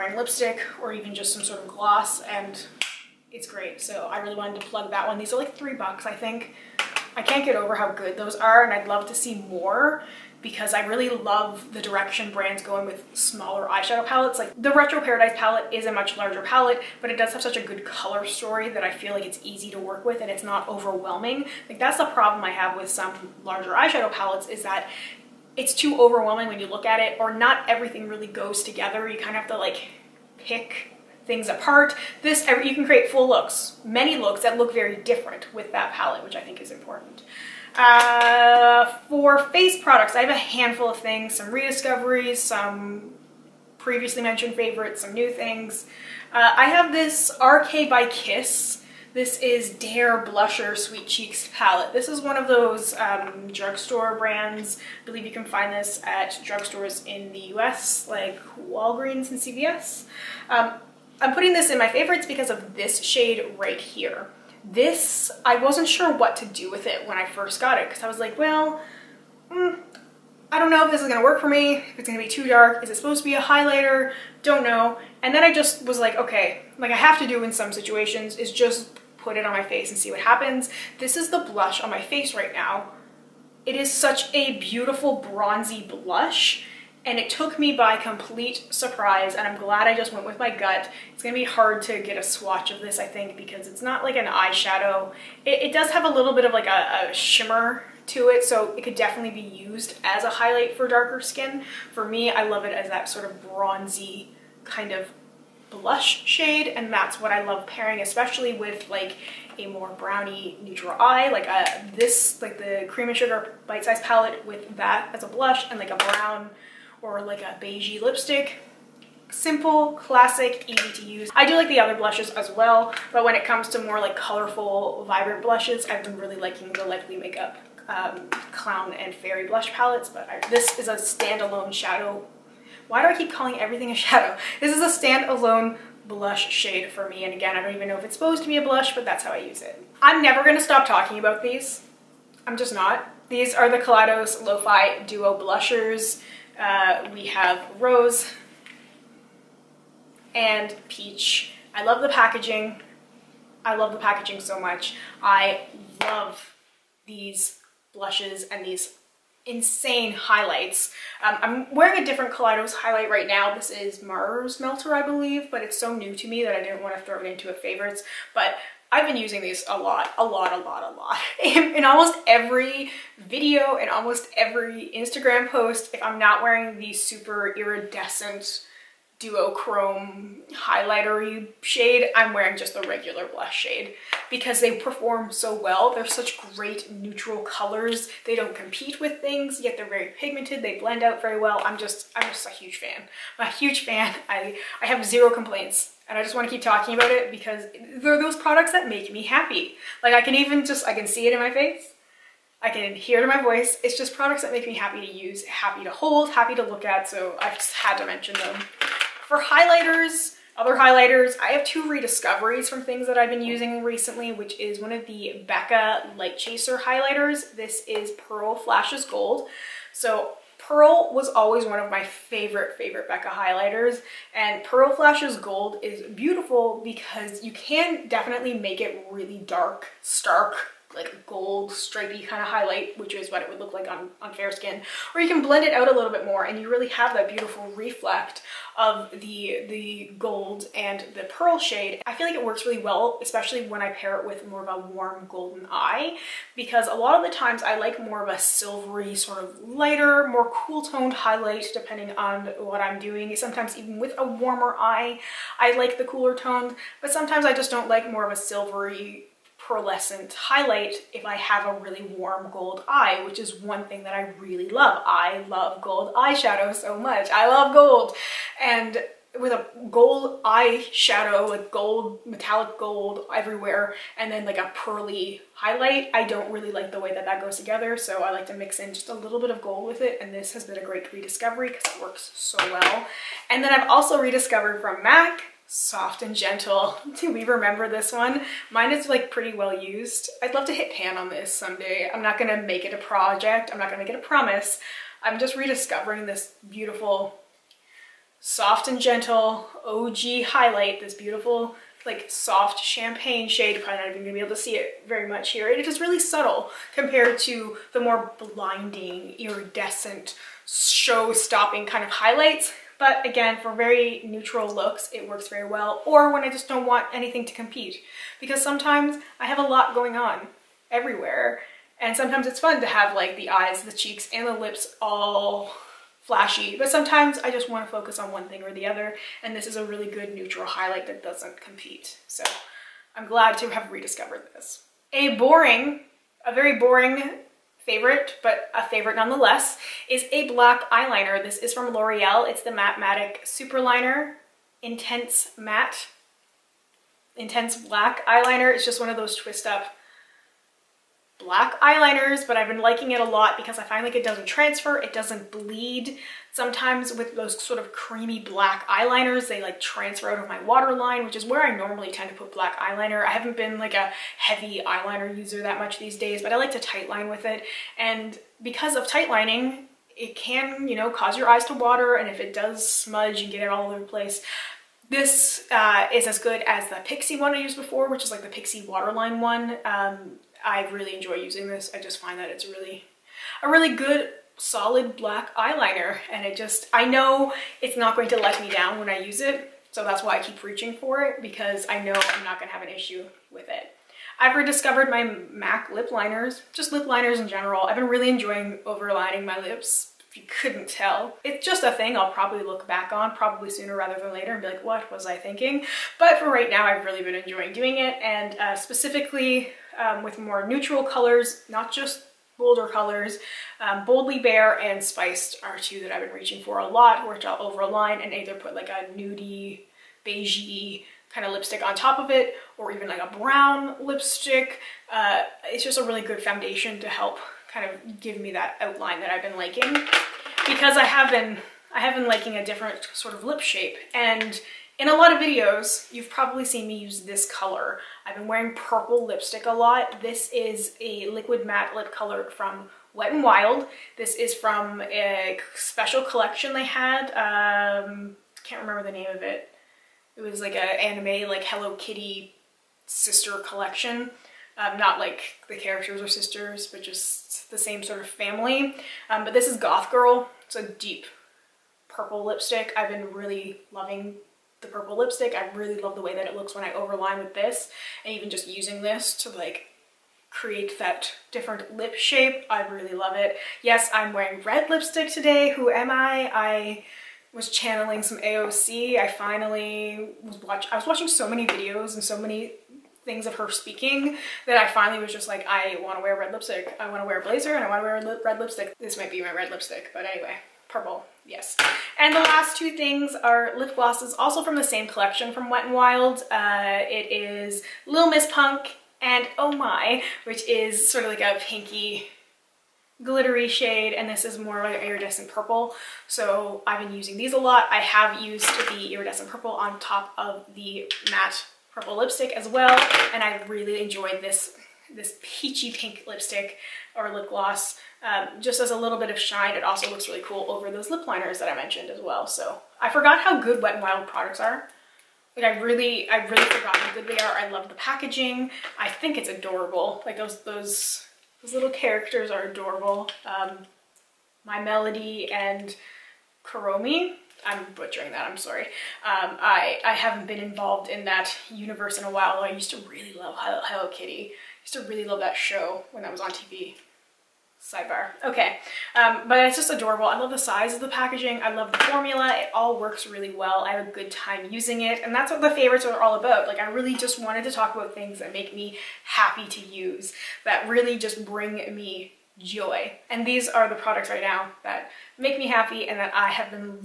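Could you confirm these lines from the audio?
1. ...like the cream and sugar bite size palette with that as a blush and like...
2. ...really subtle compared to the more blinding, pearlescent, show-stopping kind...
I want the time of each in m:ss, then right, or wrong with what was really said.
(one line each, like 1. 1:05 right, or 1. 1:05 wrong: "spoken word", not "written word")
1. 1:52 right
2. 5:05 wrong: "iridescent", not "pearlescent".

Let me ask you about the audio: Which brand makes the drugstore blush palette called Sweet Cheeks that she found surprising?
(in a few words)
RK by Kiss.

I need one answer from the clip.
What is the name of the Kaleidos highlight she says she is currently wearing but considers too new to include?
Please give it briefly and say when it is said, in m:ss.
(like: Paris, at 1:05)
Mars Melter, at 2:44.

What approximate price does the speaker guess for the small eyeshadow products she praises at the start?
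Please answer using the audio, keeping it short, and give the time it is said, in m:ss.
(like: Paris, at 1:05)
3 bucks, at 0:05.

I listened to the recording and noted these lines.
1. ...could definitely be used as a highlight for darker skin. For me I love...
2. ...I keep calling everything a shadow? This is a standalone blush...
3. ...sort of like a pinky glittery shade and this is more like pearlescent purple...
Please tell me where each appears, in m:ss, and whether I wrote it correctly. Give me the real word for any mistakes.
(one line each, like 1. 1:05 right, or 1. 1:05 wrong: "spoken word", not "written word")
1. 1:38 right
2. 2:13 right
3. 8:21 wrong: "iridescent", not "pearlescent".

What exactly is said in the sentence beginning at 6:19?
Um, I really enjoy using this.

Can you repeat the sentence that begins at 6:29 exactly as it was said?
So that's why I keep reaching for it because I know I'm not gonna have an issue with it.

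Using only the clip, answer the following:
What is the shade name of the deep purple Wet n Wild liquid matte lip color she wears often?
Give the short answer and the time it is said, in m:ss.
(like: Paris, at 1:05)
Goth Girl, at 7:39.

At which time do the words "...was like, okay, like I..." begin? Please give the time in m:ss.
1:15.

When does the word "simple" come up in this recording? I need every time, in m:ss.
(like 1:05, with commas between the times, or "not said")
1:59.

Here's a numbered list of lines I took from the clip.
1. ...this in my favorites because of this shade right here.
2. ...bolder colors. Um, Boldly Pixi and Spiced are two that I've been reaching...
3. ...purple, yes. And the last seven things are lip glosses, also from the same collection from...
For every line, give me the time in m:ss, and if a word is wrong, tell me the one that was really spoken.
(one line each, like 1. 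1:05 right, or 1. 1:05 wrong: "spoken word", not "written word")
1. 1:01 right
2. 6:52 wrong: "Bare", not "Pixi"
3. 8:10 wrong: "two", not "seven".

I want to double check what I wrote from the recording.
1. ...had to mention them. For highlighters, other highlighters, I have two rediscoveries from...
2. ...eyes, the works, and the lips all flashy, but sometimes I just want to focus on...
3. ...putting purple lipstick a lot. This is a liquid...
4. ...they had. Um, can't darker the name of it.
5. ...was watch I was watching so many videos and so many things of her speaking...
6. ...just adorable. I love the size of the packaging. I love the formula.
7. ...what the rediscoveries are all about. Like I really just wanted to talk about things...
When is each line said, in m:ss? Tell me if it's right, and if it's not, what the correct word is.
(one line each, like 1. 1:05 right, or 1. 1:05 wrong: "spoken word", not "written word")
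1. 3:27 right
2. 5:23 wrong: "cheeks", not "works"
3. 7:18 wrong: "wearing", not "putting"
4. 7:26 wrong: "remember", not "darker"
5. 8:00 right
6. 9:09 right
7. 9:15 wrong: "favorites", not "rediscoveries".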